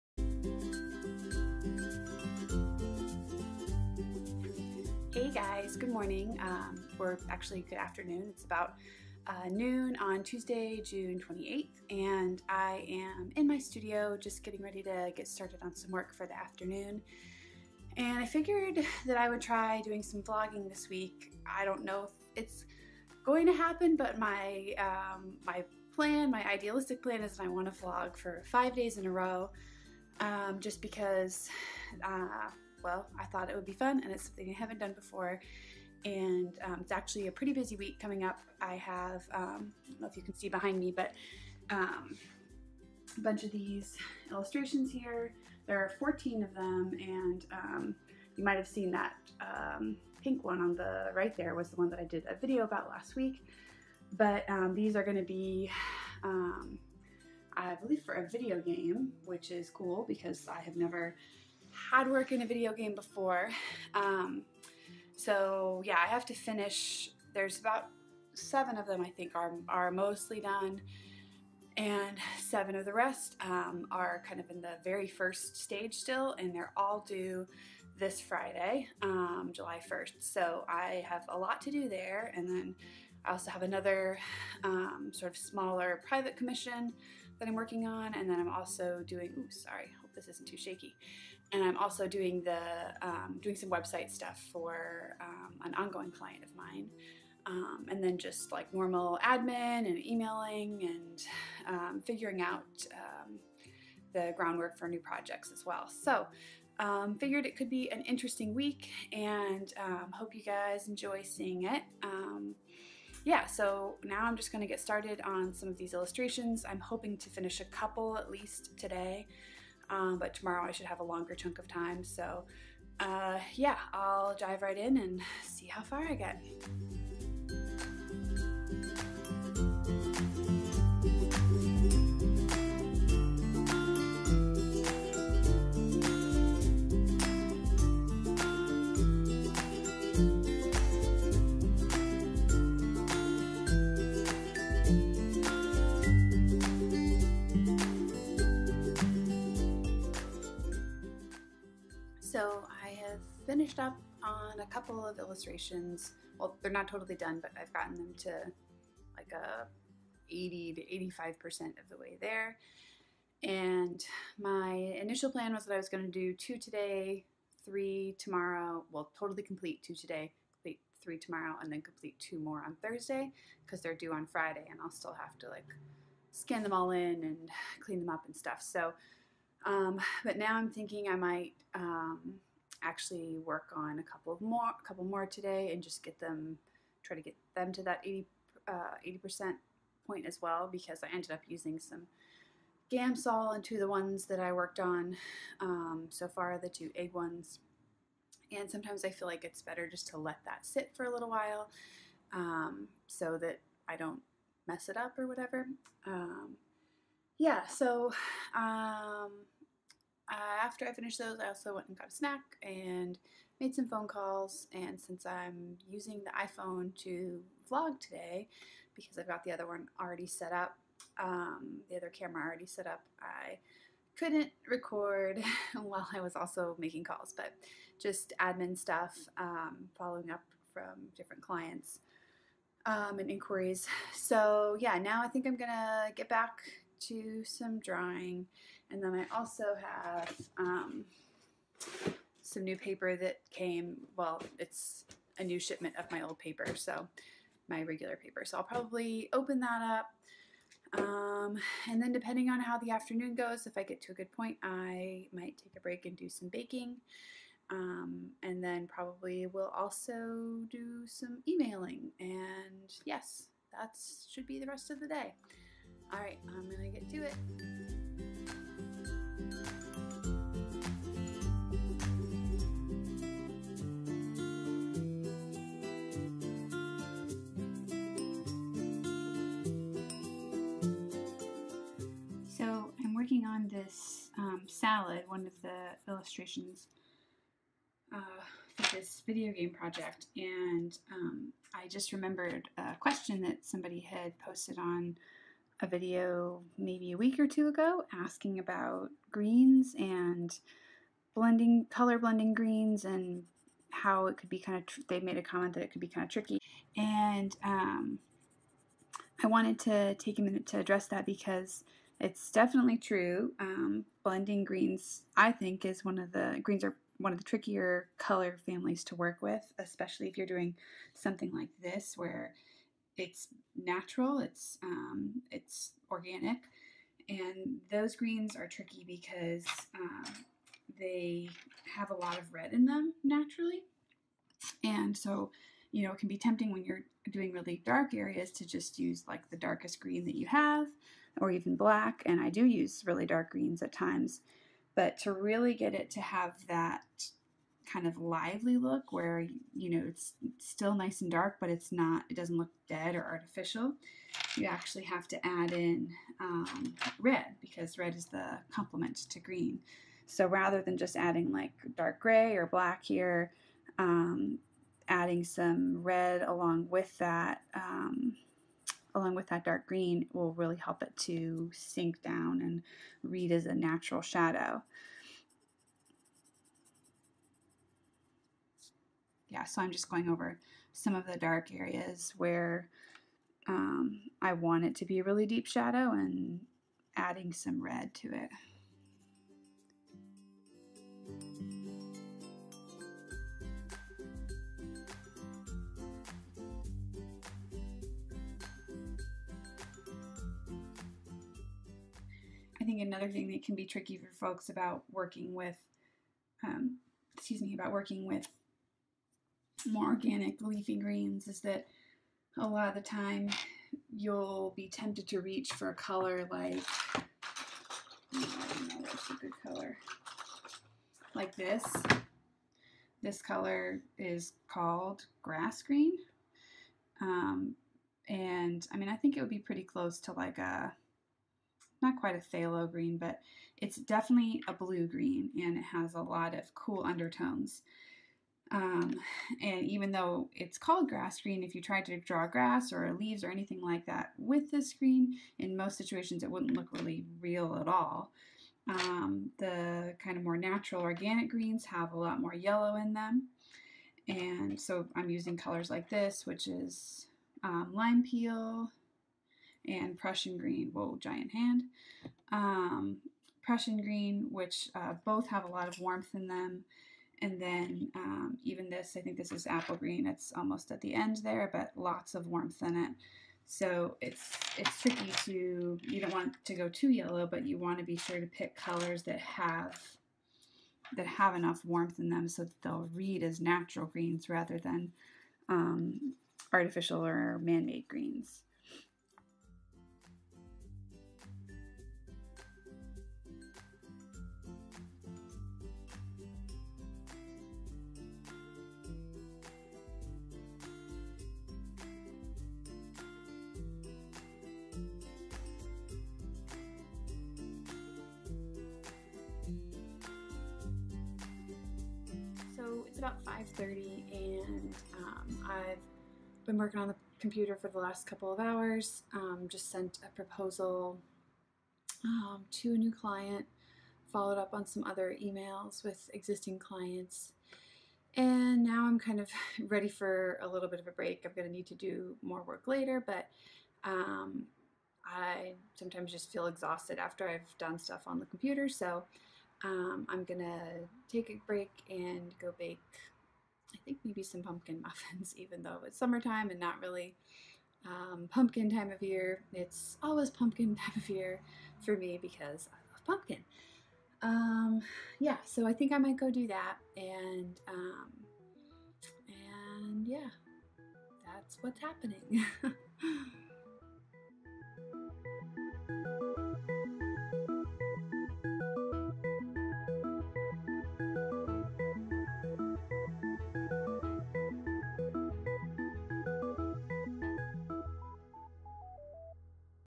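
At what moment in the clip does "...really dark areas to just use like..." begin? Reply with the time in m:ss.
5:37.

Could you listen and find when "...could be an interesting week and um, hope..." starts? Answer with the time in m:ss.
1:47.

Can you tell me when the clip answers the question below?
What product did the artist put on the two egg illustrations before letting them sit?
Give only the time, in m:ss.
3:12.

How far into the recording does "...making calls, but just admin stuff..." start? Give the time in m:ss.
3:46.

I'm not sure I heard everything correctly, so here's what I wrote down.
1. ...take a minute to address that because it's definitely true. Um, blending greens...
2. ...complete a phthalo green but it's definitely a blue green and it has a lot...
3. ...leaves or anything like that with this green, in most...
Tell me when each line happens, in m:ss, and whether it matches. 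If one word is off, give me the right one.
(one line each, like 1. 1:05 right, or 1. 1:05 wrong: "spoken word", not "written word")
1. 5:10 right
2. 7:12 wrong: "quite", not "complete"
3. 7:23 right.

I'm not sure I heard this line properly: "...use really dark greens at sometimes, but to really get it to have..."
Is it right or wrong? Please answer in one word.
wrong.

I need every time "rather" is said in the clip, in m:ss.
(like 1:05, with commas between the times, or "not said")
6:00, 8:04.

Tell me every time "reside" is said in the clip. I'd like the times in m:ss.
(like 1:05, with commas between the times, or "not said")
not said.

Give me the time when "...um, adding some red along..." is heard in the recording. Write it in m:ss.
6:03.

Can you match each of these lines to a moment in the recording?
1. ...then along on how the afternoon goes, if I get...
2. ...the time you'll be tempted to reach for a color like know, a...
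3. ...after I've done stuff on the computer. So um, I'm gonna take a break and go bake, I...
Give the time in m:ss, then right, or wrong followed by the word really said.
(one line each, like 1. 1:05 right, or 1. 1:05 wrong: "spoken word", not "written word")
1. 4:12 wrong: "depending", not "along"
2. 6:52 right
3. 8:57 right.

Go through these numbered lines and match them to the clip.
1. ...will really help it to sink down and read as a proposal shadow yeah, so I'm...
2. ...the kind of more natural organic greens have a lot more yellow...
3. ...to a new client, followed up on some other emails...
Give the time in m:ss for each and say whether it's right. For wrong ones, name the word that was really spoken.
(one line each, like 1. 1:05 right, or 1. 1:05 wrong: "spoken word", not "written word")
1. 6:10 wrong: "natural", not "proposal"
2. 7:29 right
3. 8:42 right.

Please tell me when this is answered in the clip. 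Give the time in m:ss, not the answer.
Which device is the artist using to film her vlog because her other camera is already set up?
3:36.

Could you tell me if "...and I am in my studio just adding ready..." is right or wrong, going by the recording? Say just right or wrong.
wrong.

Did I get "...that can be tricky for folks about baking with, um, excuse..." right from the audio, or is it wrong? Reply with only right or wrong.
wrong.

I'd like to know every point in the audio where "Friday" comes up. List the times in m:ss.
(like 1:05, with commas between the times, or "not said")
1:18, 2:54.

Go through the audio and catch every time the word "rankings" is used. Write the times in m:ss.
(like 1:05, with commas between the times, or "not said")
not said.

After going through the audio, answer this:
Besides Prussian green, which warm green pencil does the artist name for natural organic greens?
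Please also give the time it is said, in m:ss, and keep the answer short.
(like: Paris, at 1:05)
lime peel, at 7:37.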